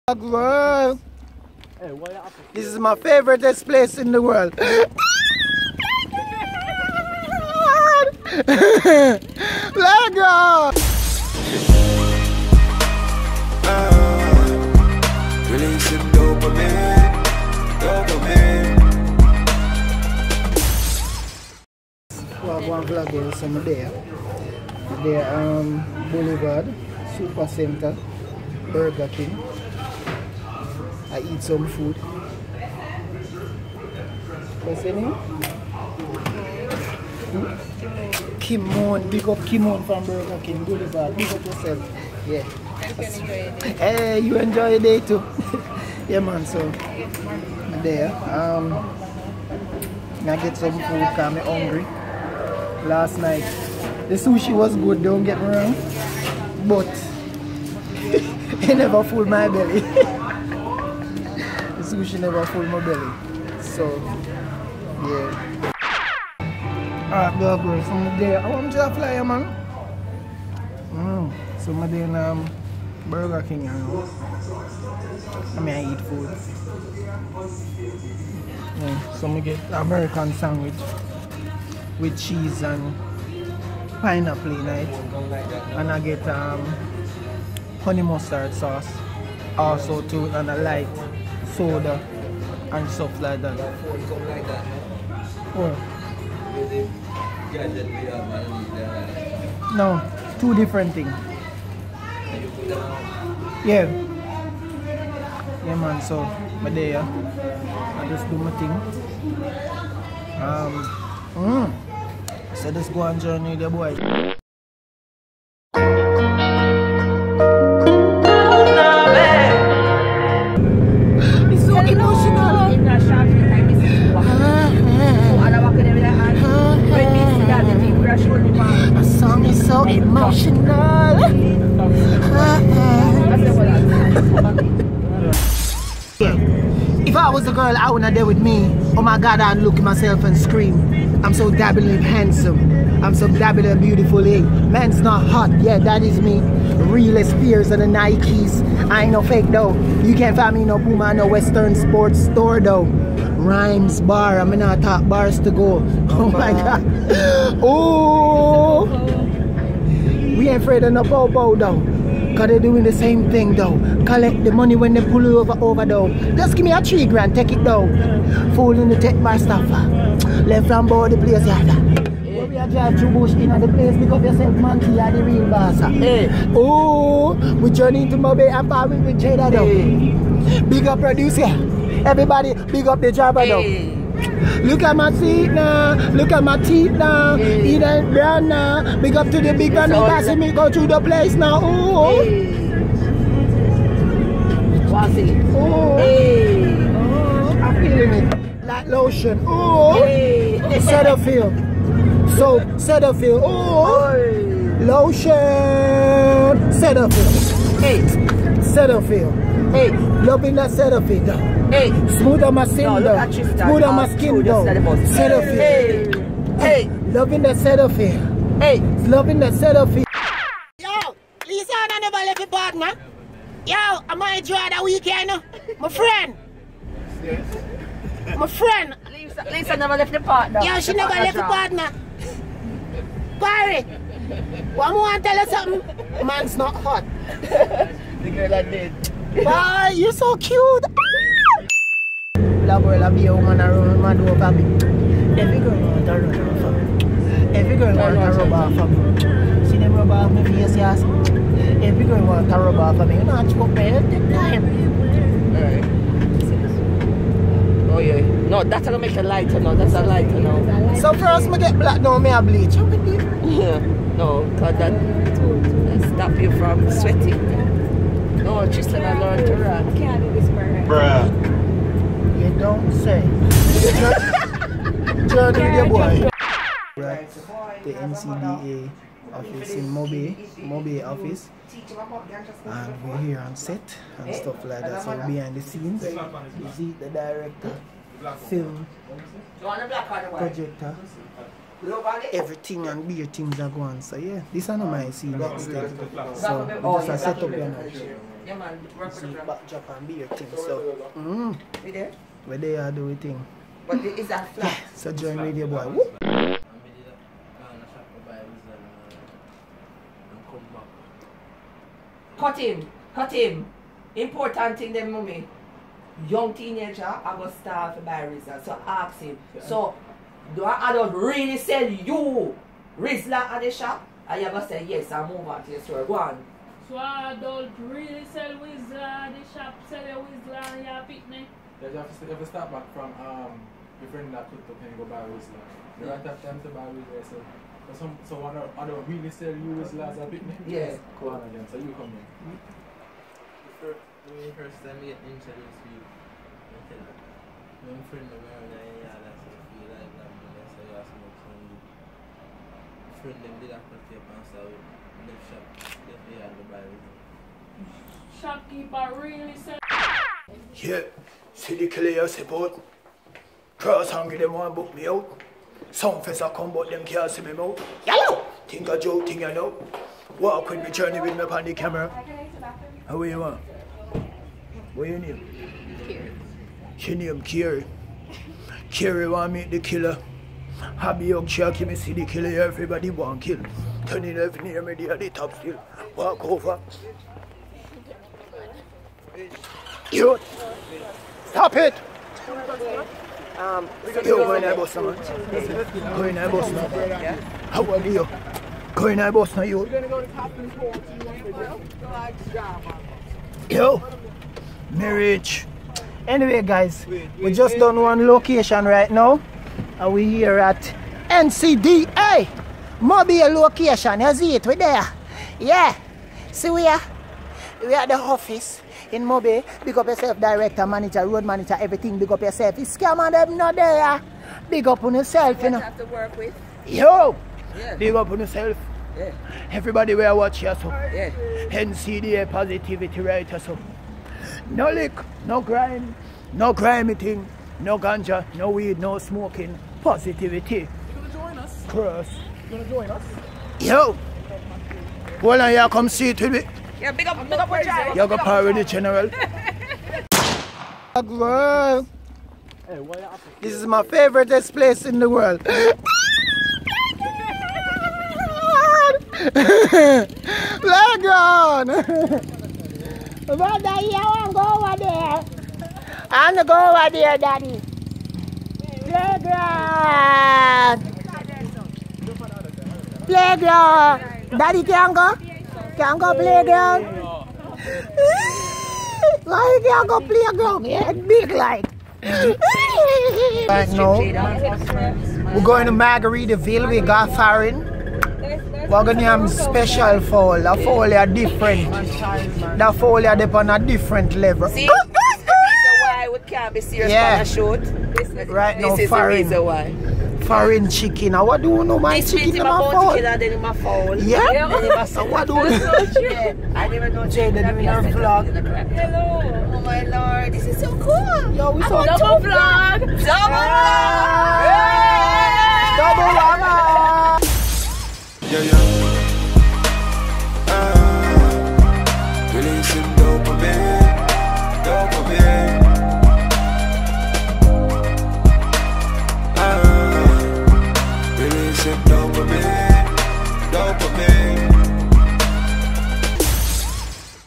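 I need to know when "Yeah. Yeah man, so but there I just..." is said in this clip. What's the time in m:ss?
1:43.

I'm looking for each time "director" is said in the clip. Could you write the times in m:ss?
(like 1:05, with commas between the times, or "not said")
4:47, 7:00.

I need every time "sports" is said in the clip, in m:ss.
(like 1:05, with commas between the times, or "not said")
2:31.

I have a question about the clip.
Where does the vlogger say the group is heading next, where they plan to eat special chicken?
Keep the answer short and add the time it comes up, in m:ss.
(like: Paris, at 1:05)
Margaritaville, at 8:05.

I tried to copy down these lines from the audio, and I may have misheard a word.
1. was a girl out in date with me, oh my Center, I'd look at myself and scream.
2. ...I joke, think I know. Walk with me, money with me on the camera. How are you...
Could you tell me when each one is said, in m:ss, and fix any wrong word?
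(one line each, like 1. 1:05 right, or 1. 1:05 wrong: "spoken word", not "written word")
1. 2:17 wrong: "God", not "Center"
2. 6:08 wrong: "journey", not "money".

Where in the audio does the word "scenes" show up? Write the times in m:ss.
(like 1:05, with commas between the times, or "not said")
4:45, 4:55.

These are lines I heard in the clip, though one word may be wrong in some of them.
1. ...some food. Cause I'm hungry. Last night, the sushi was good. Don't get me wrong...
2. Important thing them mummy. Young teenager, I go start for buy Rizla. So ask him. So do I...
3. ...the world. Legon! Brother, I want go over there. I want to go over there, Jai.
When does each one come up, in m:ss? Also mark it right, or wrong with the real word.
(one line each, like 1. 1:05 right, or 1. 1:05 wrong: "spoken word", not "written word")
1. 0:50 right
2. 5:14 right
3. 7:35 wrong: "Daddy", not "Jai".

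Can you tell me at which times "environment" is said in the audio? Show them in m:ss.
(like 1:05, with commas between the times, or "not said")
not said.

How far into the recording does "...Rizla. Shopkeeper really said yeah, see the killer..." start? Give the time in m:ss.
5:56.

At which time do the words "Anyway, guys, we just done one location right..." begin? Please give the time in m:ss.
6:46.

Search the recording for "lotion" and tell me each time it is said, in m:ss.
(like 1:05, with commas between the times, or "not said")
3:18, 3:24.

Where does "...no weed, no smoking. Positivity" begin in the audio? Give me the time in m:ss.
7:18.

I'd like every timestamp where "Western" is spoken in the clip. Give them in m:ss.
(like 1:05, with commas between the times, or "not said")
2:31.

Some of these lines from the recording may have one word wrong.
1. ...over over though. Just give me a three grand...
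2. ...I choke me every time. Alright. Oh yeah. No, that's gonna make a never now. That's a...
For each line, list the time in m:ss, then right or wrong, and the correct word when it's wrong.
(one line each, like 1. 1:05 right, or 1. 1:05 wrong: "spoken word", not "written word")
1. 2:45 right
2. 4:13 wrong: "lighter", not "never".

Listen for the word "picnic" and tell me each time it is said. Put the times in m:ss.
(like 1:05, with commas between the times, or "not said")
5:31.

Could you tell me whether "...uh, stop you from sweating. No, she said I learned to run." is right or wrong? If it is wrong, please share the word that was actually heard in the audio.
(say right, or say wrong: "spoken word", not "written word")
right.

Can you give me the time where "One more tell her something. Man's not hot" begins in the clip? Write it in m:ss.
3:54.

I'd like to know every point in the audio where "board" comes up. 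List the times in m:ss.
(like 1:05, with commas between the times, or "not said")
2:50.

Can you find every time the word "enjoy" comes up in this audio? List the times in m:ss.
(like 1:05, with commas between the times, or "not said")
0:44, 3:44.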